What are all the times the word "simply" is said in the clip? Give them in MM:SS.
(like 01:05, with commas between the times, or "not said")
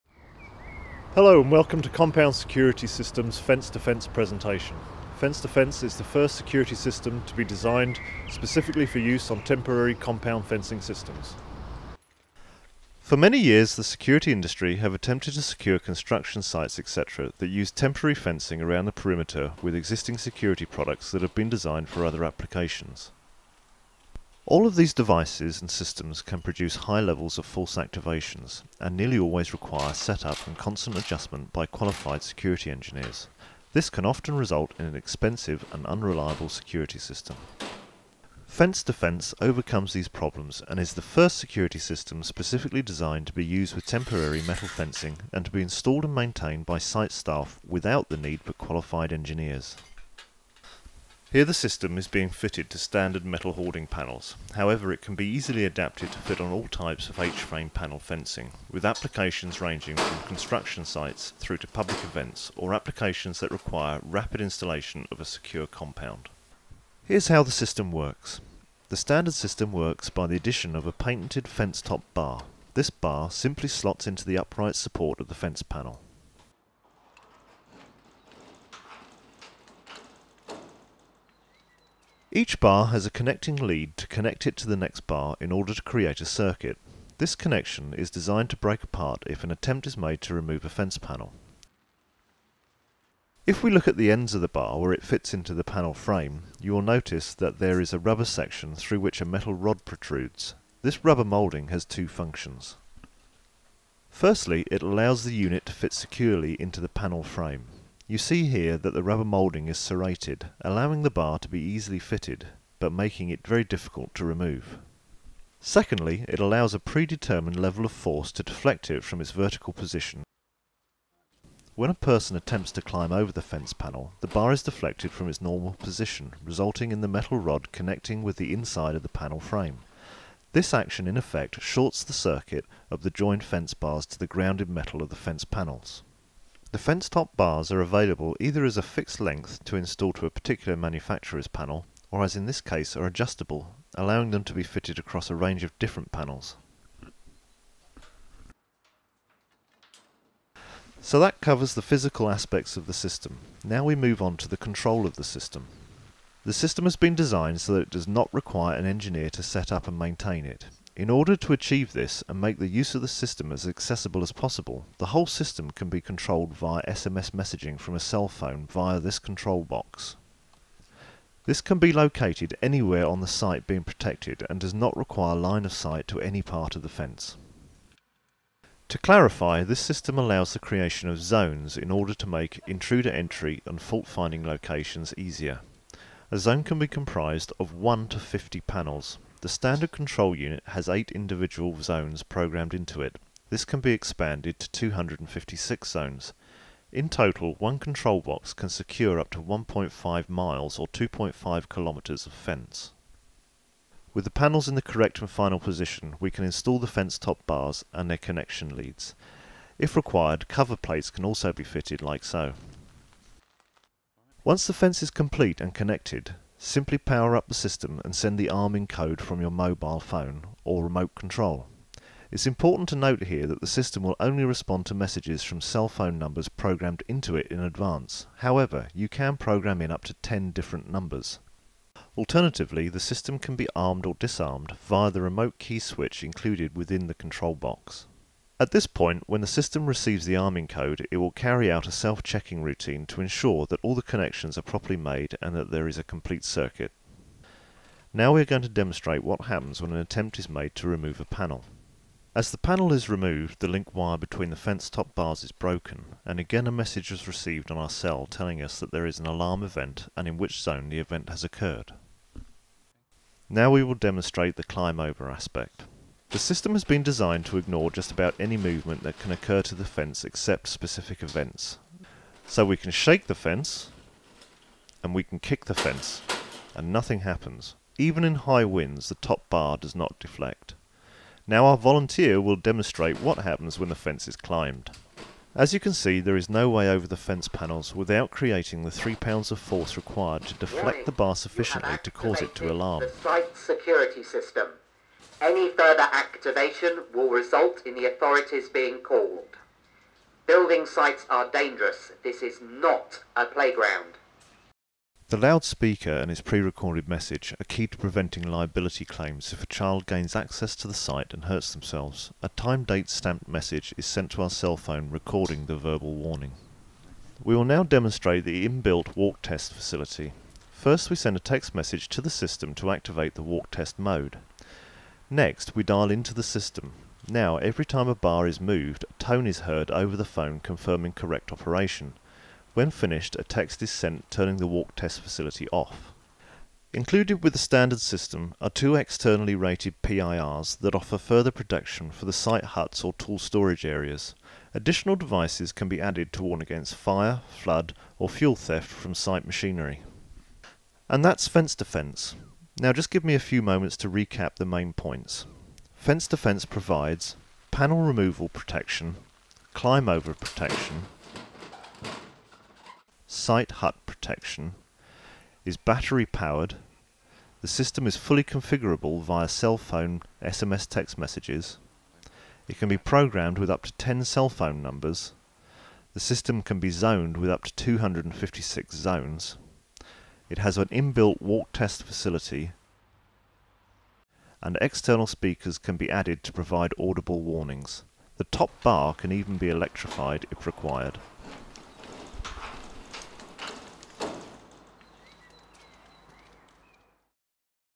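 01:13, 03:36.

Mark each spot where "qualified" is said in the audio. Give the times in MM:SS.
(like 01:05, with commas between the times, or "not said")
00:31, 00:48.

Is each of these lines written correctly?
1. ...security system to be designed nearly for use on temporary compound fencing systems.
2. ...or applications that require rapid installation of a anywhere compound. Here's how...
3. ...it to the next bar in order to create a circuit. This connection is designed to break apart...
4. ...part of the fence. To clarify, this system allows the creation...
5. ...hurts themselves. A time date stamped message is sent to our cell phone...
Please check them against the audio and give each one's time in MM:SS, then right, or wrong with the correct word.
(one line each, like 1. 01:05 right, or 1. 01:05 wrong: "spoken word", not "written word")
1. 00:06 wrong: "specifically", not "nearly"
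2. 01:02 wrong: "secure", not "anywhere"
3. 01:24 right
4. 02:56 right
5. 05:11 right.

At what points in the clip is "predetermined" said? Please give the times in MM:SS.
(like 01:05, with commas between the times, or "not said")
01:56.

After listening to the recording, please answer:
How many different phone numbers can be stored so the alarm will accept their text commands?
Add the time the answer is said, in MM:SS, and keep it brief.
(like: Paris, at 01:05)
10, at 03:49.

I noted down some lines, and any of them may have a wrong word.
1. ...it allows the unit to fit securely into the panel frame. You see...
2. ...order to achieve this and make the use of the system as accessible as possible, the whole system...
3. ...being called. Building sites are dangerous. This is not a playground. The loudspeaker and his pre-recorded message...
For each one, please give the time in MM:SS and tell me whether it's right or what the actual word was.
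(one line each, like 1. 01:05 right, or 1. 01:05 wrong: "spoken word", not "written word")
1. 01:44 right
2. 02:41 right
3. 04:58 right.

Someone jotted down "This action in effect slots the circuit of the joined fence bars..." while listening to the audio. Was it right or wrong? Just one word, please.
wrong.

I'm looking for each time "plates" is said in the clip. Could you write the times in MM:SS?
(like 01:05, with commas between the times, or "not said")
03:30.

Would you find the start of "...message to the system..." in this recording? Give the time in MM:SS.
05:21.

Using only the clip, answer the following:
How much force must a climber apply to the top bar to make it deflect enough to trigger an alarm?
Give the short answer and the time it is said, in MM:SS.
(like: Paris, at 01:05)
3 pounds, at 04:48.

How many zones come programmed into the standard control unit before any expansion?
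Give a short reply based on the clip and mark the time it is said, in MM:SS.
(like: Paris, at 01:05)
8, at 03:10.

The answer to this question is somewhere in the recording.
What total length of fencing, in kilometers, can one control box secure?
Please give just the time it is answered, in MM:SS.
03:20.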